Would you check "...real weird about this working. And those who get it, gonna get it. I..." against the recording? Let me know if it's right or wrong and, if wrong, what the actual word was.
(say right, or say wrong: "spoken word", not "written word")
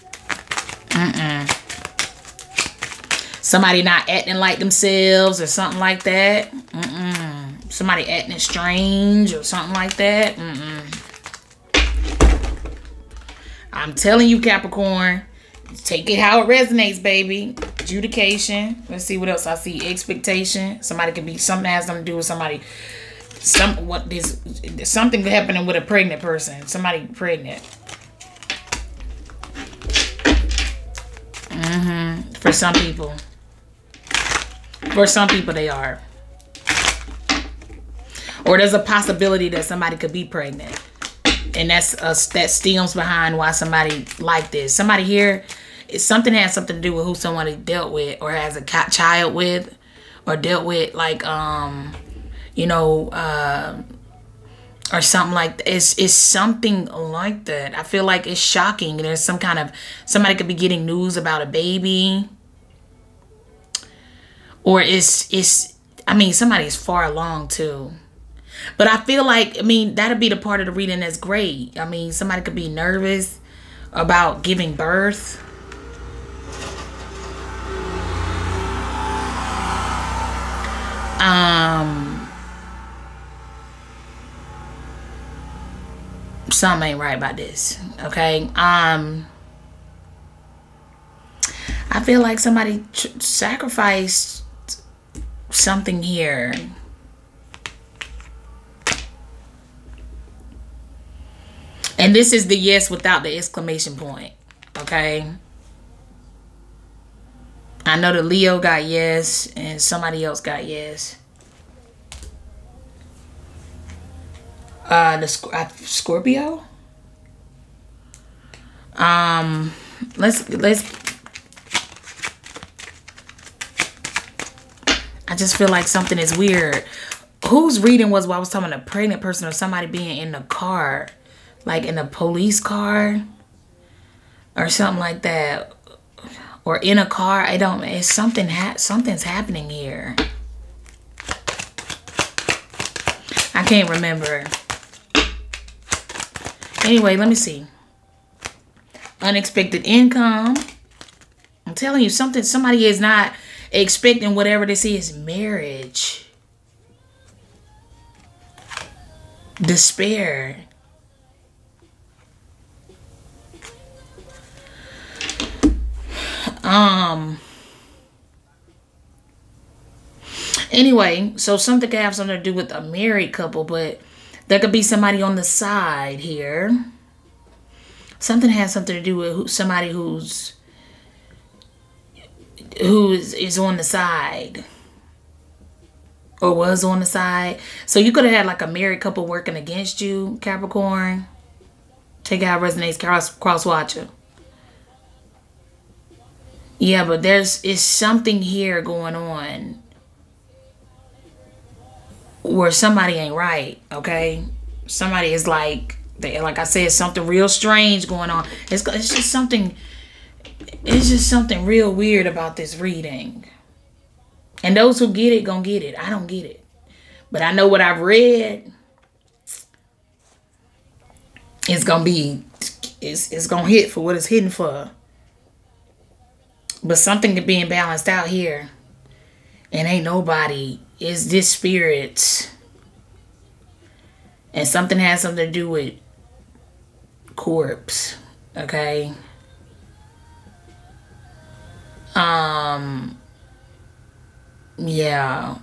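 wrong: "reading", not "working".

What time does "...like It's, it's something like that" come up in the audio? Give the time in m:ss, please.
0:55.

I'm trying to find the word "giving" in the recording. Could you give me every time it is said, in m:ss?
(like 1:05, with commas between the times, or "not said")
1:14.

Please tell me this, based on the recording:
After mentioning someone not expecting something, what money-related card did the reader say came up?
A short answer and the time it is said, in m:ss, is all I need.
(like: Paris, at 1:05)
Unexpected income, at 2:29.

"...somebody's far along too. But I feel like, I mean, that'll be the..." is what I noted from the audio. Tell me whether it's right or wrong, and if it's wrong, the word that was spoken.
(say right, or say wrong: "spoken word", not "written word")
right.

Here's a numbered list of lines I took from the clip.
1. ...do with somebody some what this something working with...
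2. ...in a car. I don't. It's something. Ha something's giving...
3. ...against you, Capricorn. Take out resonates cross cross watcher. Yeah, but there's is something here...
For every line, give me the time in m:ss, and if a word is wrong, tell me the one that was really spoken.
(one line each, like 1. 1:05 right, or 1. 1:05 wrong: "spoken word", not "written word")
1. 0:22 wrong: "happening", not "working"
2. 2:16 wrong: "happening", not "giving"
3. 3:09 right.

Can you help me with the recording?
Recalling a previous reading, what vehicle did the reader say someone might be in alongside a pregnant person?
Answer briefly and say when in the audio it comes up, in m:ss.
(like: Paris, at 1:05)
Police car, at 2:12.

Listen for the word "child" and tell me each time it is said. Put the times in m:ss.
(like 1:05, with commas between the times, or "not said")
0:48.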